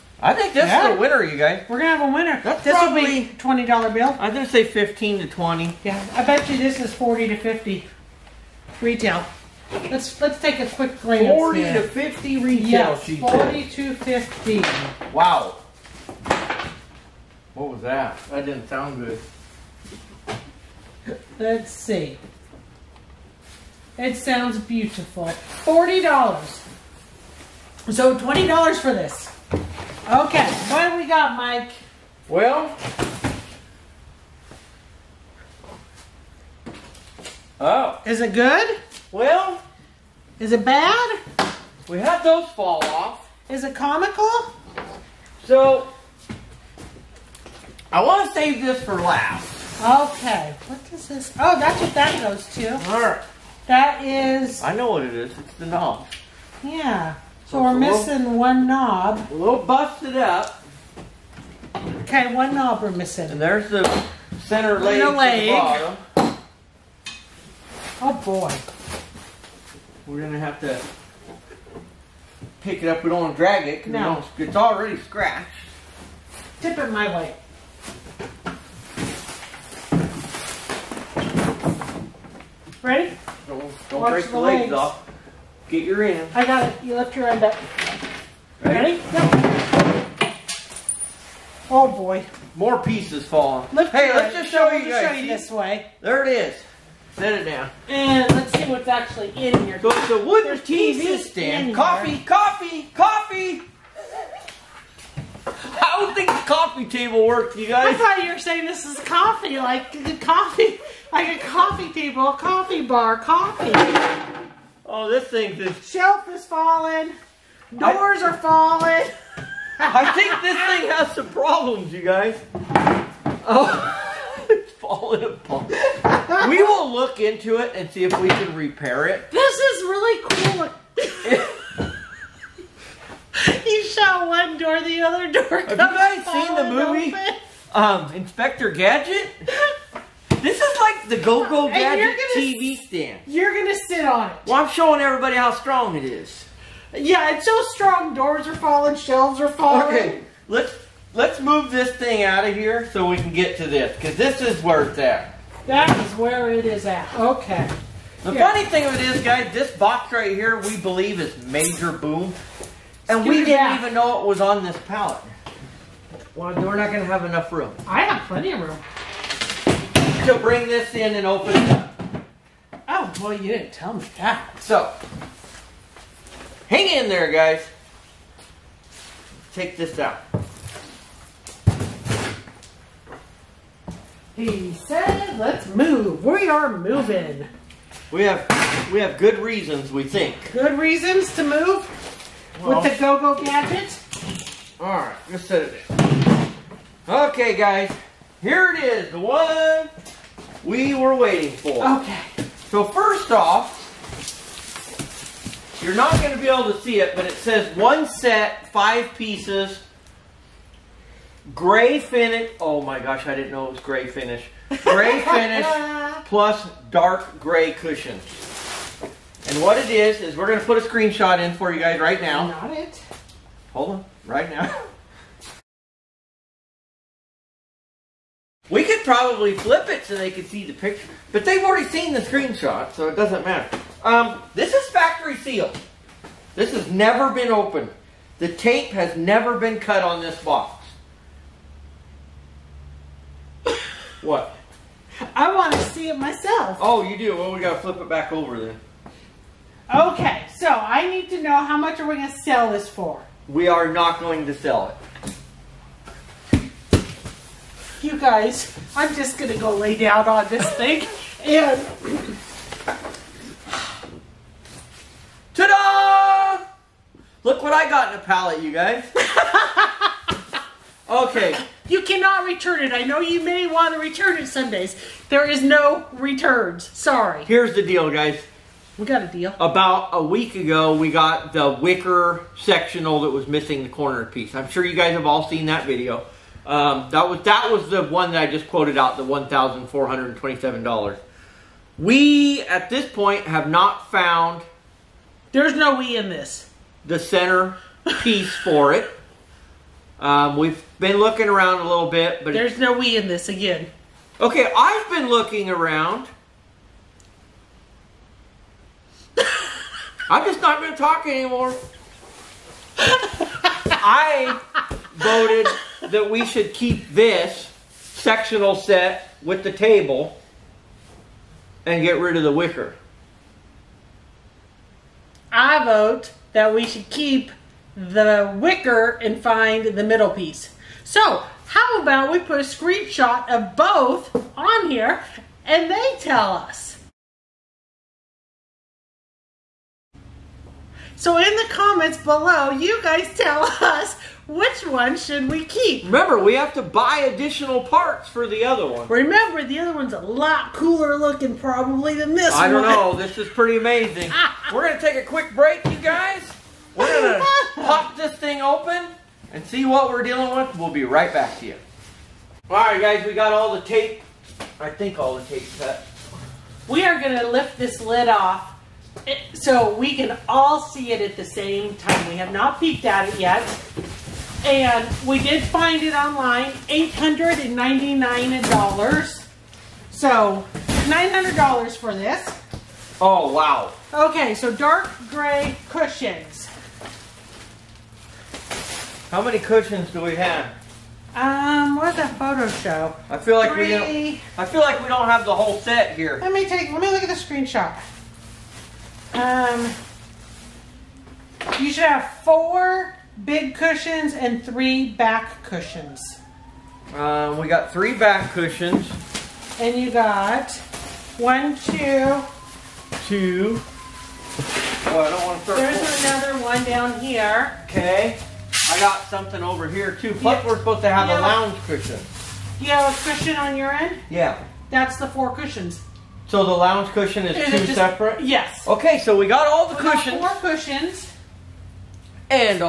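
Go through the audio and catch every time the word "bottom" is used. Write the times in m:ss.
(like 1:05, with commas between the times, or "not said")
1:05.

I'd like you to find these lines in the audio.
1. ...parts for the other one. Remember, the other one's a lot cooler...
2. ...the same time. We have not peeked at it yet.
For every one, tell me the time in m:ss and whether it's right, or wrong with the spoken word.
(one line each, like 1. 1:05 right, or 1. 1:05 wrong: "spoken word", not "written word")
1. 5:47 right
2. 6:11 right.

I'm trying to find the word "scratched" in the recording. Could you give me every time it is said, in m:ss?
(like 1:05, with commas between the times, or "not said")
1:14.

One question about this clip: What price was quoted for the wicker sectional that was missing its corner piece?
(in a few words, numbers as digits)
$1,427.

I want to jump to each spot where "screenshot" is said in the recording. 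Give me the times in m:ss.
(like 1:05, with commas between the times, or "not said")
3:40, 3:52, 5:32, 6:37.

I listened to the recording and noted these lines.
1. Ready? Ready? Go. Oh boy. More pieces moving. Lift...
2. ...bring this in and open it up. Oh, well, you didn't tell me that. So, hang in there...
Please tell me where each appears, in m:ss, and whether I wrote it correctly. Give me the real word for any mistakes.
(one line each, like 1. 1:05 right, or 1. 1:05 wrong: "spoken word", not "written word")
1. 1:28 wrong: "falling", not "moving"
2. 2:50 right.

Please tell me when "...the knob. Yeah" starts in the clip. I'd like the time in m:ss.
0:55.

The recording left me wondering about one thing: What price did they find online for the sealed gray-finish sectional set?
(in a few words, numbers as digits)
$899.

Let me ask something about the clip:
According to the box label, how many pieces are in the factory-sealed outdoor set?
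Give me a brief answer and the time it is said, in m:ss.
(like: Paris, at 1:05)
5, at 3:28.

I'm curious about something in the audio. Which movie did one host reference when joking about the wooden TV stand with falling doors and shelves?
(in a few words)
Inspector Gadget.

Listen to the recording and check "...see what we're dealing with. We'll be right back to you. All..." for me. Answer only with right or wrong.
right.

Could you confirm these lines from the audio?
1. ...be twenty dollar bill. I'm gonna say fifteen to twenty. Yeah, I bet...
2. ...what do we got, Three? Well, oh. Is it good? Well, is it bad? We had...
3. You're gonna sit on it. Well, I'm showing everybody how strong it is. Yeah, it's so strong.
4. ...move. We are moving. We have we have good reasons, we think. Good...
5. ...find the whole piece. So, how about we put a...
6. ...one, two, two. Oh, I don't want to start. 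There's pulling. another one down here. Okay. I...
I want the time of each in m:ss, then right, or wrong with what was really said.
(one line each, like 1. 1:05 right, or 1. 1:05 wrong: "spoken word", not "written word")
1. 0:03 right
2. 0:30 wrong: "Mike", not "Three"
3. 2:23 right
4. 3:05 right
5. 5:29 wrong: "middle", not "whole"
6. 6:51 right.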